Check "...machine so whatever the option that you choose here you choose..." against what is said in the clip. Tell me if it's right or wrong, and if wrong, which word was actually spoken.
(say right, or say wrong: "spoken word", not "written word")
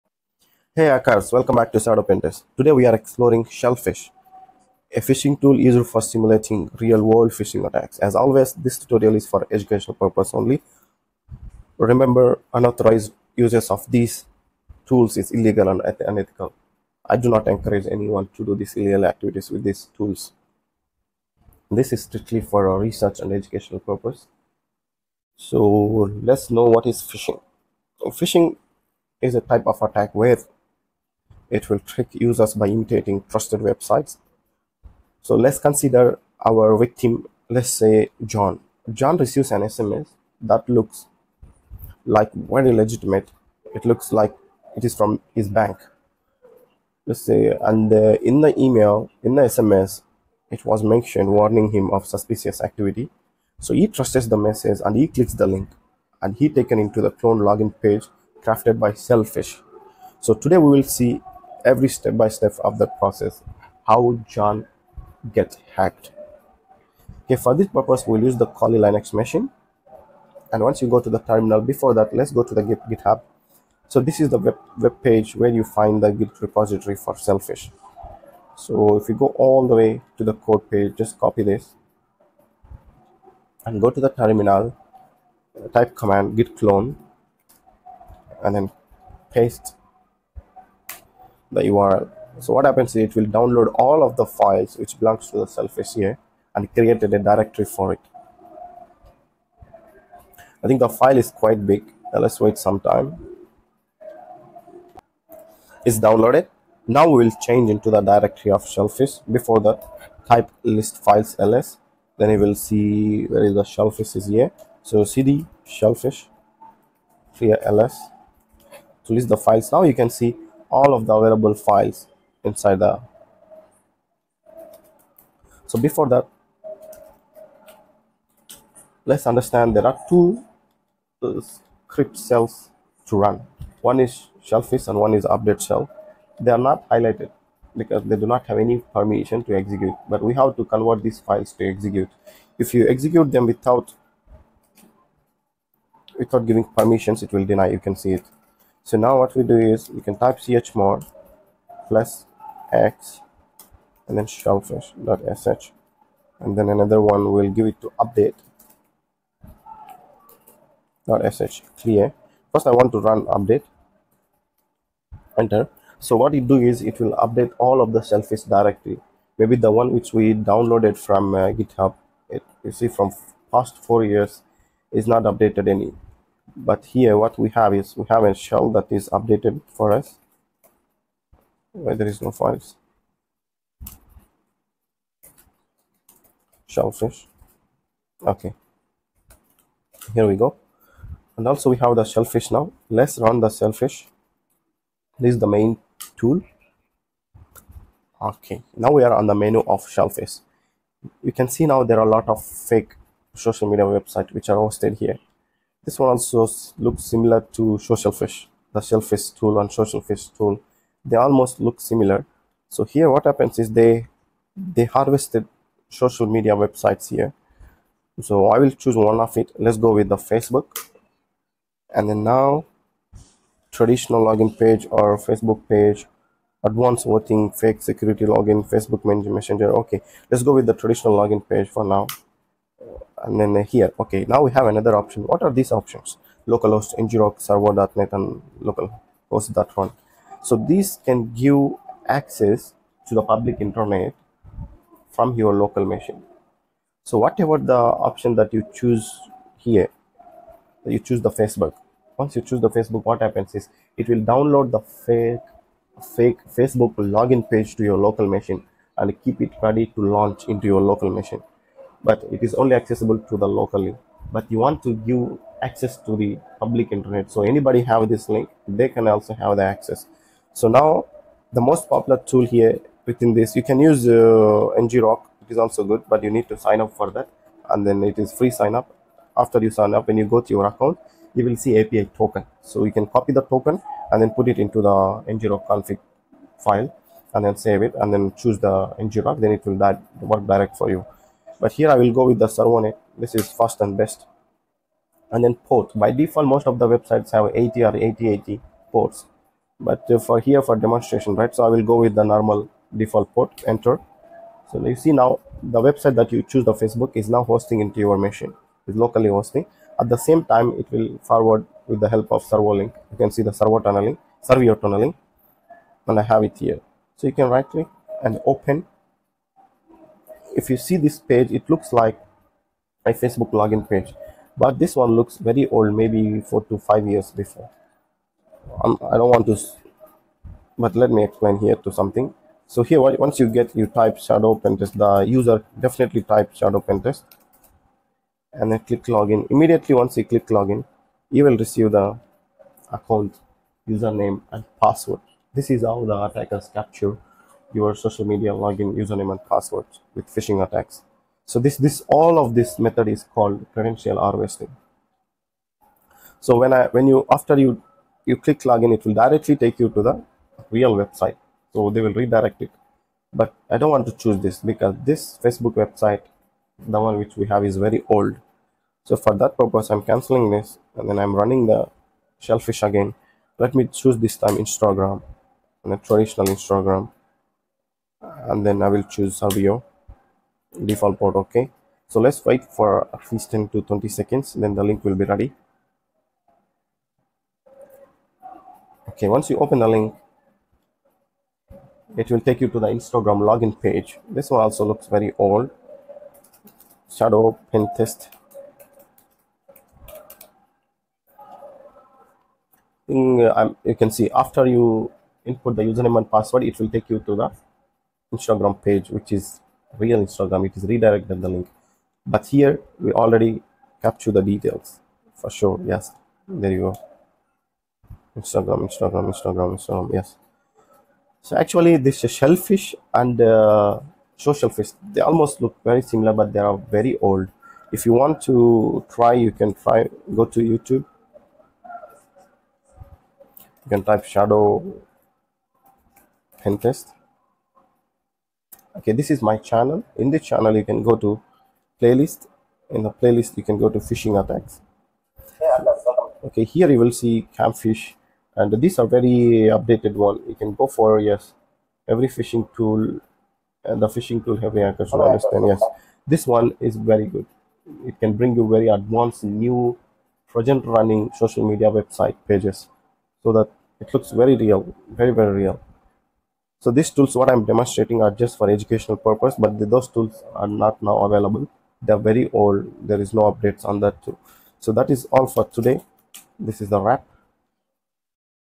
right.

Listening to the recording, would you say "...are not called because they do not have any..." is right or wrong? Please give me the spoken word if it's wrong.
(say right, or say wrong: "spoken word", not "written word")
wrong: "highlighted", not "called".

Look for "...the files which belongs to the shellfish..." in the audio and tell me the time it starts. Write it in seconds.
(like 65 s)
94 s.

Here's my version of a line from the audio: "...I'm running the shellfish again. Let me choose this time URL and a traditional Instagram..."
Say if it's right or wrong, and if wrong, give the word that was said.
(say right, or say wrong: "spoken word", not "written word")
wrong: "Instagram", not "URL".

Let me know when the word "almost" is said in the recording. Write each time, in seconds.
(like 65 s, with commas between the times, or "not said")
211 s, 425 s.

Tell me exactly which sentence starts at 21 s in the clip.
This is strictly for research and educational purpose.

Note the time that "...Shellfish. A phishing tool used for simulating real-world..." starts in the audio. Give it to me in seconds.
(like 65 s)
3 s.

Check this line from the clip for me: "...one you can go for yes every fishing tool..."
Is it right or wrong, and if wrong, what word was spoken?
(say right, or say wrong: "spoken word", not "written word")
right.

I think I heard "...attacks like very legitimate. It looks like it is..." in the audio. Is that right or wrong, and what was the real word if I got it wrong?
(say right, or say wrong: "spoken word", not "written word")
wrong: "looks", not "attacks".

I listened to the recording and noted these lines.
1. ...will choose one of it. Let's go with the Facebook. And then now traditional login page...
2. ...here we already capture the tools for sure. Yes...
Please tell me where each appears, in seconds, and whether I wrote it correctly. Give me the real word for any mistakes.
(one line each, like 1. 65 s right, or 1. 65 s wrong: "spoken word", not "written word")
1. 218 s right
2. 412 s wrong: "details", not "tools".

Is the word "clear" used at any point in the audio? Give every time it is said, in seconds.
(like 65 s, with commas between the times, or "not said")
117 s, 161 s.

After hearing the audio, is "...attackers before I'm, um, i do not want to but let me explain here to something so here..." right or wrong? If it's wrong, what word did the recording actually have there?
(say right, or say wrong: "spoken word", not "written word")
wrong: "years", not "attackers".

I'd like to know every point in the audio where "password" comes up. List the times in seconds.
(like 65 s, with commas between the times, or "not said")
344 s, 349 s, 406 s.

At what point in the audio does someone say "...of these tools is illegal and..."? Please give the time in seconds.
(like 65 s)
13 s.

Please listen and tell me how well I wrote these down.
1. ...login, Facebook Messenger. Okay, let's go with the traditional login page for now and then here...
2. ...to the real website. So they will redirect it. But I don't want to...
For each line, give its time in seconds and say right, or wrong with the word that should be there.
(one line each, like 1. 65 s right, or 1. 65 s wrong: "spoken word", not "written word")
1. 228 s right
2. 359 s right.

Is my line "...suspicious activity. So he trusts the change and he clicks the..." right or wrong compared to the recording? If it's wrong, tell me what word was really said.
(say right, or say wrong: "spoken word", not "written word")
wrong: "message", not "change".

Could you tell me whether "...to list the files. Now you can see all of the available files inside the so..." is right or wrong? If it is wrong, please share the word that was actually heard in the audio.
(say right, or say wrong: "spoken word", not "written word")
right.